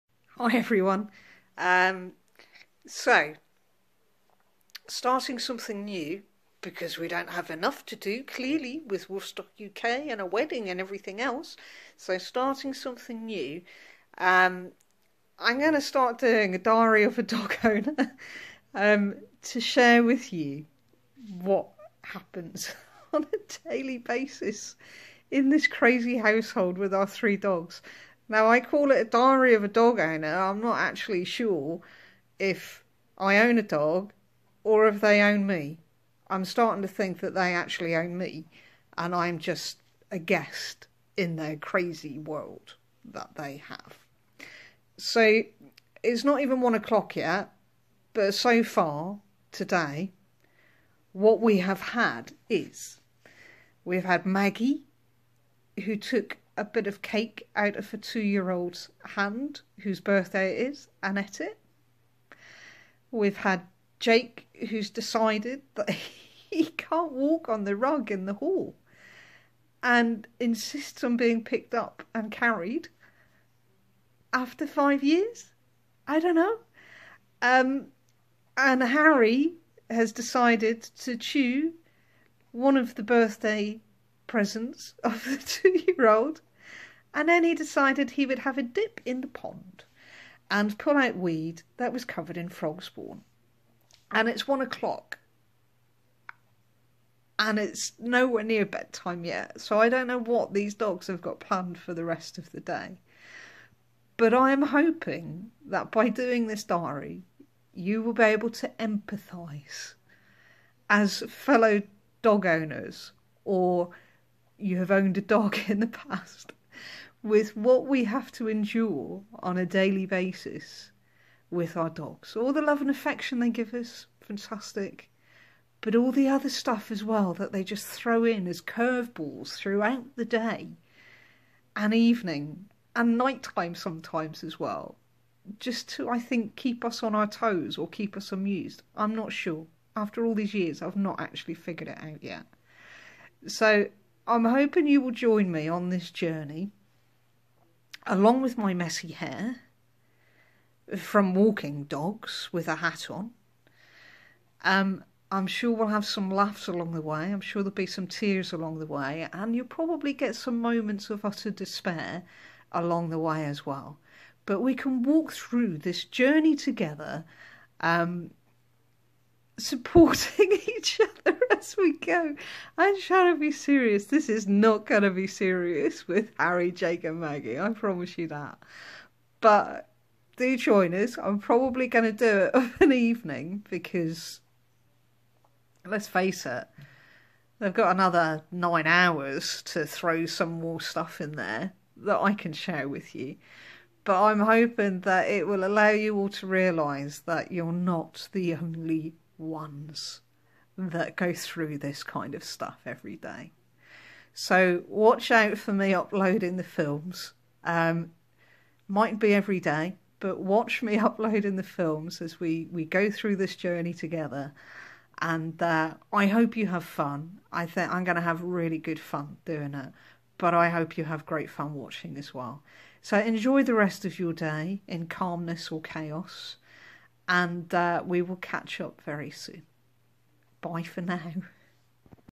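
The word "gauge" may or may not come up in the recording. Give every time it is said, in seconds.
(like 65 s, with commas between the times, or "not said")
not said.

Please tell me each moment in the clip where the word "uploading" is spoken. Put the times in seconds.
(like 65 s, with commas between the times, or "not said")
205 s, 210 s.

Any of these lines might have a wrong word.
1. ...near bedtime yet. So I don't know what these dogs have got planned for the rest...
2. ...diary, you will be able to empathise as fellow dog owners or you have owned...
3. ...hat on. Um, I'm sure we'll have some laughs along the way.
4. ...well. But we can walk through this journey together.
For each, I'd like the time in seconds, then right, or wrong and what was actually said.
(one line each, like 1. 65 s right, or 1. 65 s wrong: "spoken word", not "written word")
1. 98 s right
2. 106 s right
3. 152 s right
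4. 163 s right.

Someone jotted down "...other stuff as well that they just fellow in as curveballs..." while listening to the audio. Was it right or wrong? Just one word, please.
wrong.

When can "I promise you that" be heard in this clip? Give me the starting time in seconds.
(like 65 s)
177 s.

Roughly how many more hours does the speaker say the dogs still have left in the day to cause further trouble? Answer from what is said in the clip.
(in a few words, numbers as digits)
9.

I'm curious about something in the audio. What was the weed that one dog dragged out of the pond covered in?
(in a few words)
Frog spawn.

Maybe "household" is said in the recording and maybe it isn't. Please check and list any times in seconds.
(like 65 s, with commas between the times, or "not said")
26 s.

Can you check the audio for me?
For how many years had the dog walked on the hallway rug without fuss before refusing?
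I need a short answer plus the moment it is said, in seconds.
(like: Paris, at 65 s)
5, at 74 s.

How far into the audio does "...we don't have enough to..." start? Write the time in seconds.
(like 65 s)
6 s.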